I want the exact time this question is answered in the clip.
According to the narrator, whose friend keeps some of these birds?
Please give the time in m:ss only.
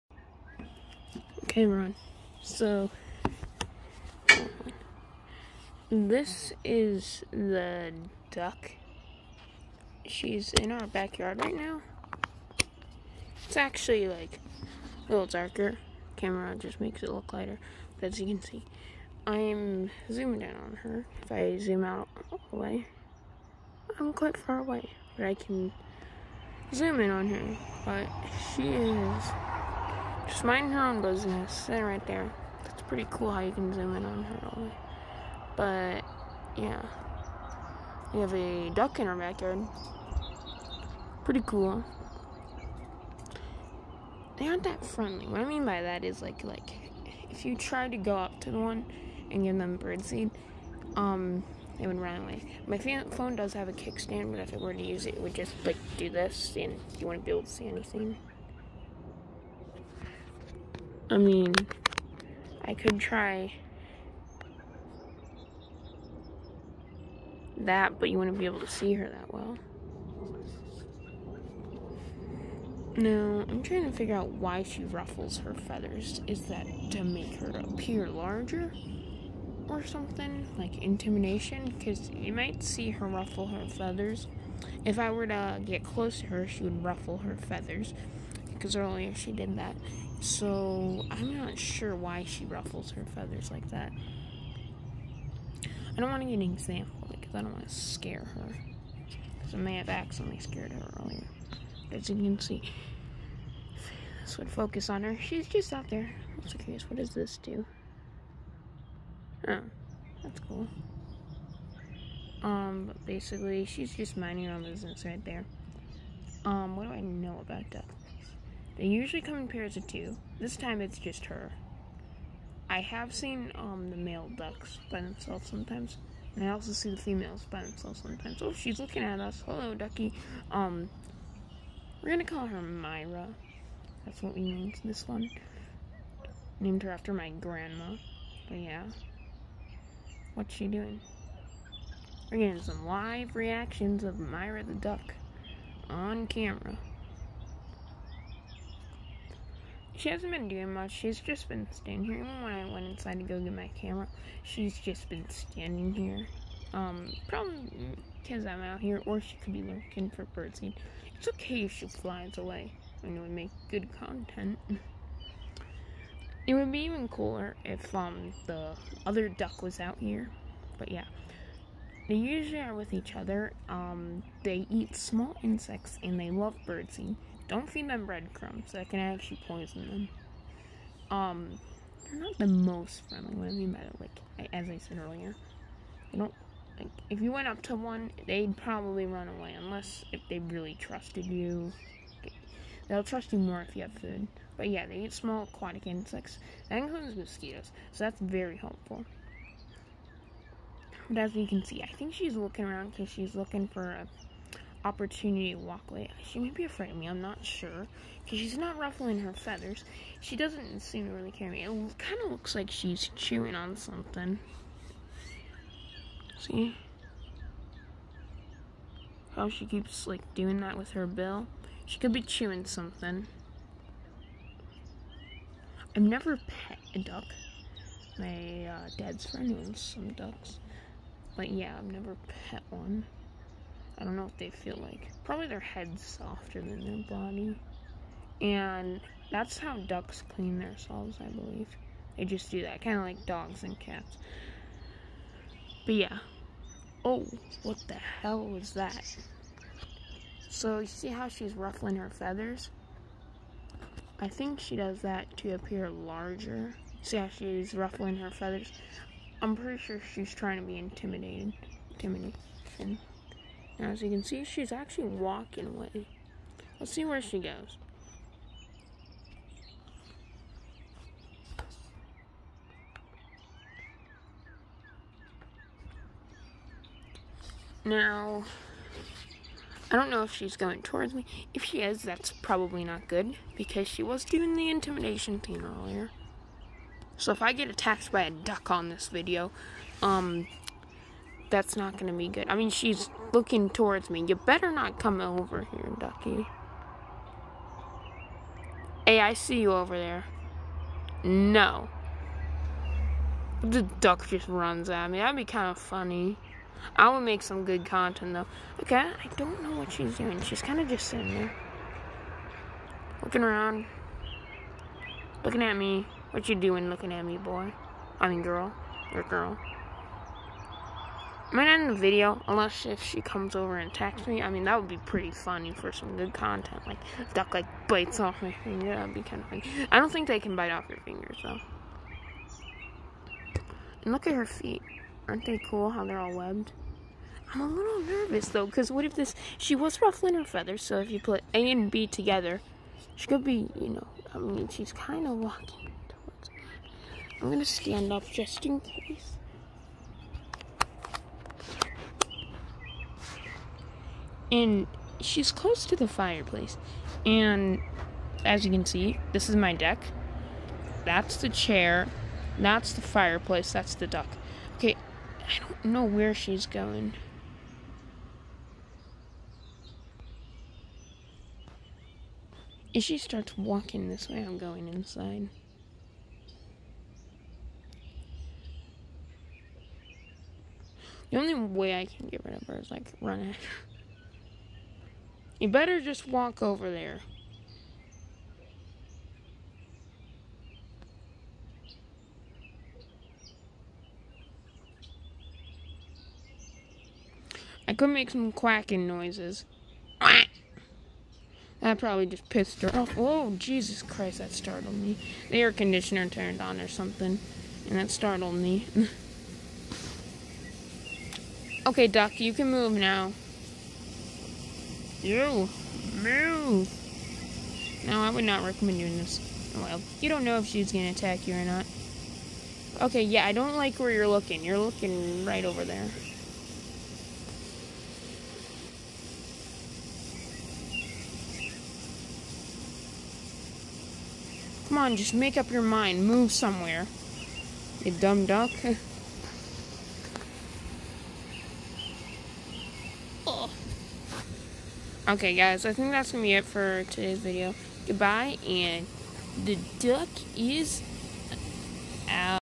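3:48.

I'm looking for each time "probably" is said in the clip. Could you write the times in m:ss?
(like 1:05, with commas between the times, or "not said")
2:37, 3:08, 3:55, 4:42, 6:41.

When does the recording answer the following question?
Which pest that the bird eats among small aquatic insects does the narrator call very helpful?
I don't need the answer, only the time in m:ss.
3:17.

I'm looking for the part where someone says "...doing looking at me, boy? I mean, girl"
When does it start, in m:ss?
5:16.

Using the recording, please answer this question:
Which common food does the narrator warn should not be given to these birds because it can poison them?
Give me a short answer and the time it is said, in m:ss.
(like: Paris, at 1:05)
Breadcrumbs, at 2:58.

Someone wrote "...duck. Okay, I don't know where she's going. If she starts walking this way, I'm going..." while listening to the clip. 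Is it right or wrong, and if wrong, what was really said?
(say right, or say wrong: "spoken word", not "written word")
right.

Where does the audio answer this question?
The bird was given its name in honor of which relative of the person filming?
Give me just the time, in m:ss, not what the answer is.
2:17.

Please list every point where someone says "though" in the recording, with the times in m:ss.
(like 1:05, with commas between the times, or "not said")
5:08, 5:31, 5:38.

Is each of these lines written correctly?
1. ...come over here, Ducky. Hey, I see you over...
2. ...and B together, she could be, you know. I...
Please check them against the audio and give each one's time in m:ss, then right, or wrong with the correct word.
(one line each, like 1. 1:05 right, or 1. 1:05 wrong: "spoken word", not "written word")
1. 4:54 right
2. 5:41 right.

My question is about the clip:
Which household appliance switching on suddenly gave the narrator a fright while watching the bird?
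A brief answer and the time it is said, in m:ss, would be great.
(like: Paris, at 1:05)
Air conditioner, at 6:45.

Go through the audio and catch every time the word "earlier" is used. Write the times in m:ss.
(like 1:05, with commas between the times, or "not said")
1:28, 1:40, 3:05, 4:45.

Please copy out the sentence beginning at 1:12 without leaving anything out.
Now, I'm trying to figure out why she ruffles her feathers.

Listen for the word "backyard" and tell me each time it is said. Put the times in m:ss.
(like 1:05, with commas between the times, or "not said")
0:10, 0:39.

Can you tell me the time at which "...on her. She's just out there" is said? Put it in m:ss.
1:44.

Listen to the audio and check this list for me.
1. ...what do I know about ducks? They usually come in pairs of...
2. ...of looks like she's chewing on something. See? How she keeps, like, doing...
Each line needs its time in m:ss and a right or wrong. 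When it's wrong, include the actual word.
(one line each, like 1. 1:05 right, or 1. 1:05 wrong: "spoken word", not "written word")
1. 1:56 right
2. 3:32 right.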